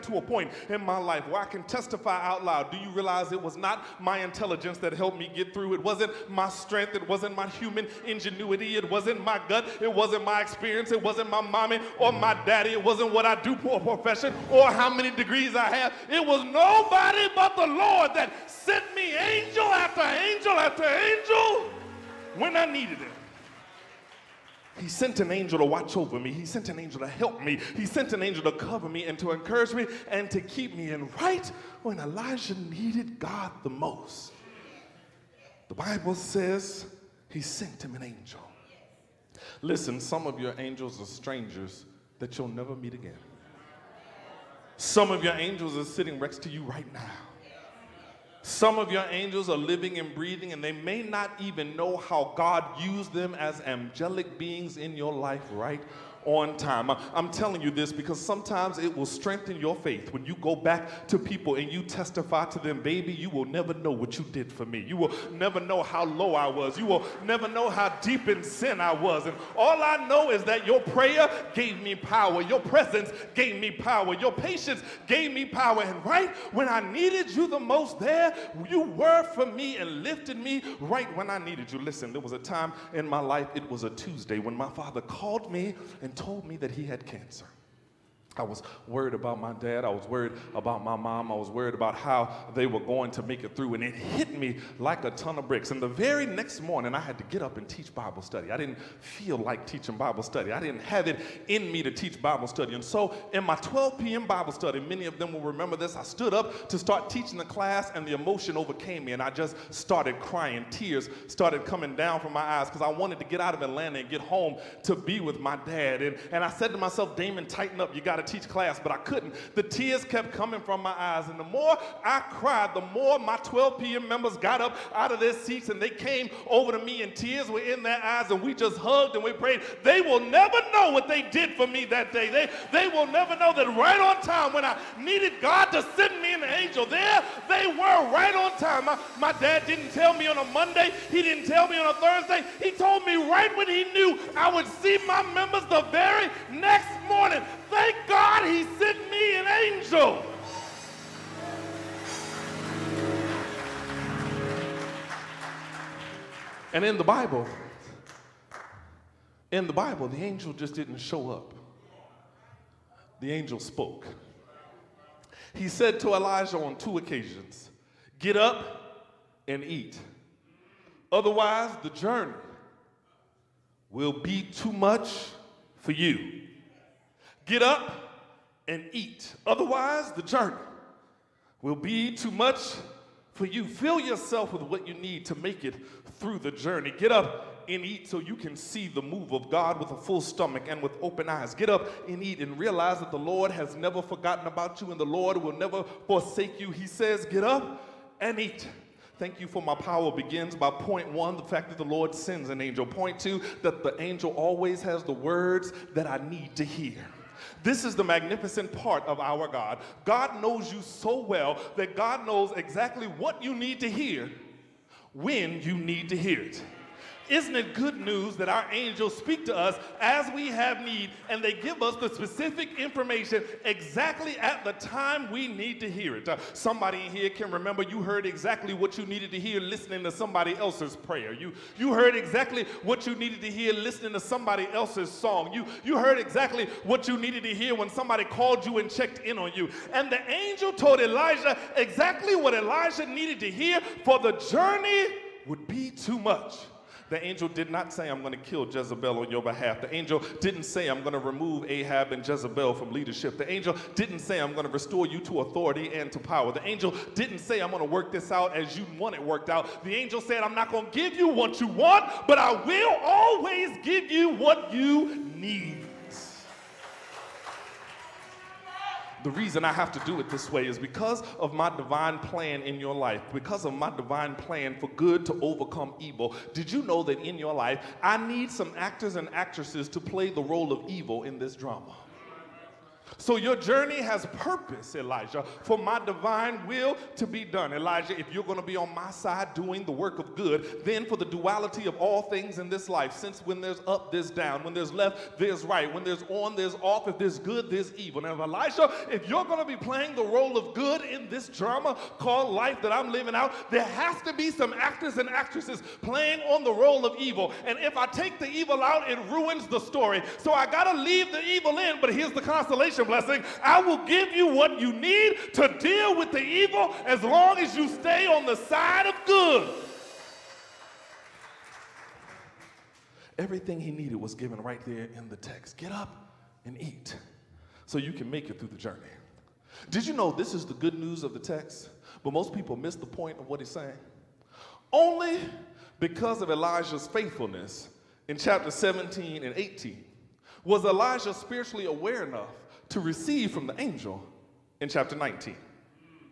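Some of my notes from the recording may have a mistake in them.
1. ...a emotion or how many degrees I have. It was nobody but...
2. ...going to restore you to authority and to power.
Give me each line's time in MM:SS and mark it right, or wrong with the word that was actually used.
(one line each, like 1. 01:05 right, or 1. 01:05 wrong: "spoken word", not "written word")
1. 00:13 wrong: "profession", not "emotion"
2. 04:14 right.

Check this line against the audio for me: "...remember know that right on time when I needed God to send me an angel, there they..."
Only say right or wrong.
wrong.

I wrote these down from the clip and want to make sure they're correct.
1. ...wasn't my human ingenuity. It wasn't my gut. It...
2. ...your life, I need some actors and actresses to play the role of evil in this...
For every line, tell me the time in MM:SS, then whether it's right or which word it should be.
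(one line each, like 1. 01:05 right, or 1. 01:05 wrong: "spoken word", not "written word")
1. 00:07 right
2. 04:37 right.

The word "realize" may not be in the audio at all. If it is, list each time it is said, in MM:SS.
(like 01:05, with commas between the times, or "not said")
00:02, 03:12.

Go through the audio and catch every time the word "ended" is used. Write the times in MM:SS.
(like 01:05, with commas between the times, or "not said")
not said.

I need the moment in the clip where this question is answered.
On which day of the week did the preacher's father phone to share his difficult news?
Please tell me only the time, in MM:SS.
01:23.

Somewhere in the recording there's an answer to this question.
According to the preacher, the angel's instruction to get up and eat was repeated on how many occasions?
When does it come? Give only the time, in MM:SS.
02:46.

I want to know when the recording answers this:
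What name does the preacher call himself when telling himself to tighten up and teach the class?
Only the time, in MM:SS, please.
01:57.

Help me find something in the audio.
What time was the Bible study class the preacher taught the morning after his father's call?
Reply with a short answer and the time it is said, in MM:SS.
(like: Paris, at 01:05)
12 p.m., at 01:43.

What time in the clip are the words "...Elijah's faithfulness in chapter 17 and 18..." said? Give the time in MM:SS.
05:36.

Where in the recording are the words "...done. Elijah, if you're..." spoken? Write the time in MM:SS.
04:47.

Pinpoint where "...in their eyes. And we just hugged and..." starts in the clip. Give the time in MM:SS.
02:07.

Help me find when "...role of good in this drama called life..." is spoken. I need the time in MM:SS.
05:00.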